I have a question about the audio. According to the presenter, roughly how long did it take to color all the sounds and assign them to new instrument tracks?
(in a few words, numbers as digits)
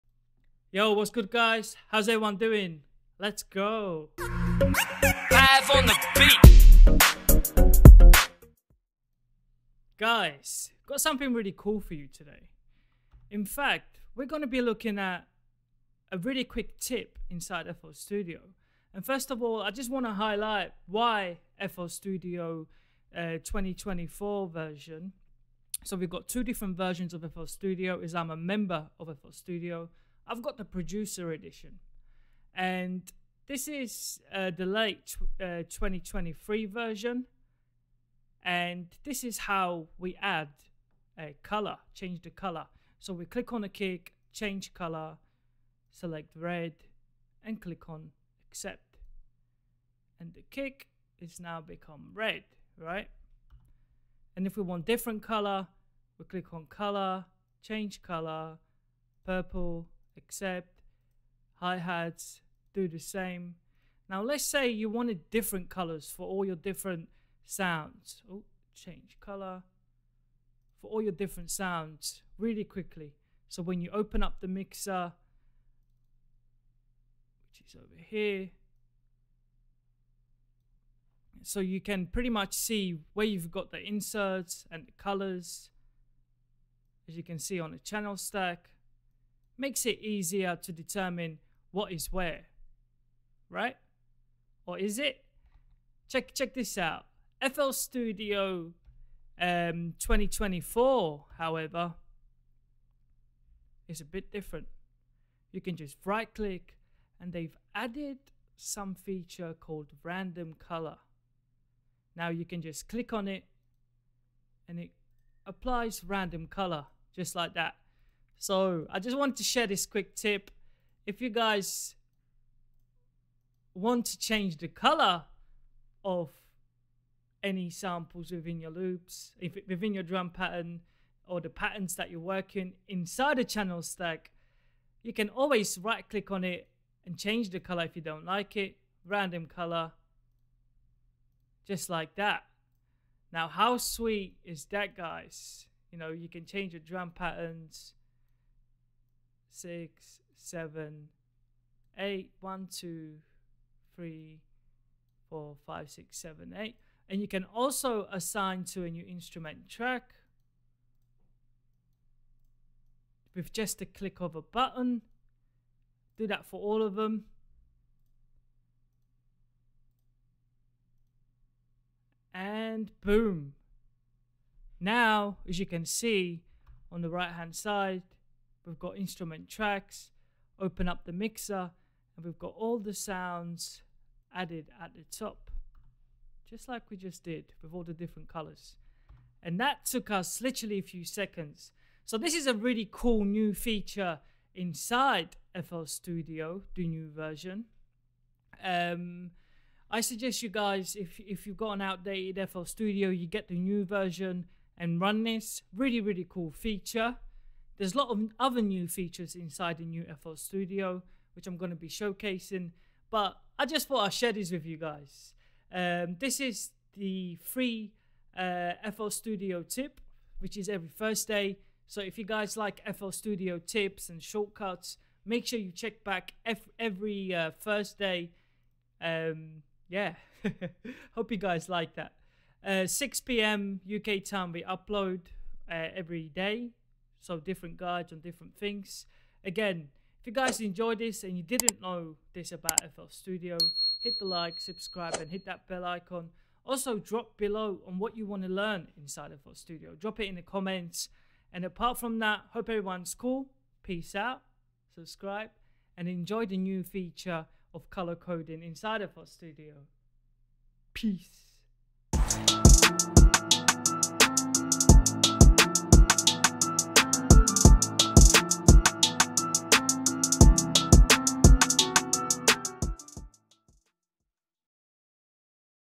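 a few seconds.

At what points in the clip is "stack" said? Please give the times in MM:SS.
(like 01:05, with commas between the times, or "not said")
01:28, 02:13.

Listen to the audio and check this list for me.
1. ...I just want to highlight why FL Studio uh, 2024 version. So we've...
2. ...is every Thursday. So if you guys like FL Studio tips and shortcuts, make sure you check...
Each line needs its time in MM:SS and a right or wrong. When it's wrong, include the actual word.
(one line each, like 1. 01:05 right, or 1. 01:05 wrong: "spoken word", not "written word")
1. 00:19 right
2. 03:40 right.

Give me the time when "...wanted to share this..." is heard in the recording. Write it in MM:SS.
01:59.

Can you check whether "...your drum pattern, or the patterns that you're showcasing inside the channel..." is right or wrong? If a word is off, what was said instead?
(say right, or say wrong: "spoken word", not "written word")
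wrong: "working", not "showcasing".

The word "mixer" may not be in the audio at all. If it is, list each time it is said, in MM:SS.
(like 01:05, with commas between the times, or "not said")
01:14, 03:01.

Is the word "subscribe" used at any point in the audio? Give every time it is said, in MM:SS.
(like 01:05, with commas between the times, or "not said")
04:04, 04:14.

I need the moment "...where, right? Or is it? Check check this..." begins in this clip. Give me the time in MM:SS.
01:32.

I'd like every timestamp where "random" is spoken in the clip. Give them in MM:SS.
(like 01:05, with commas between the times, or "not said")
01:50, 01:56, 02:19.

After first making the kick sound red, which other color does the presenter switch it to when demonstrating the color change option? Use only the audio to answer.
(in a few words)
purple.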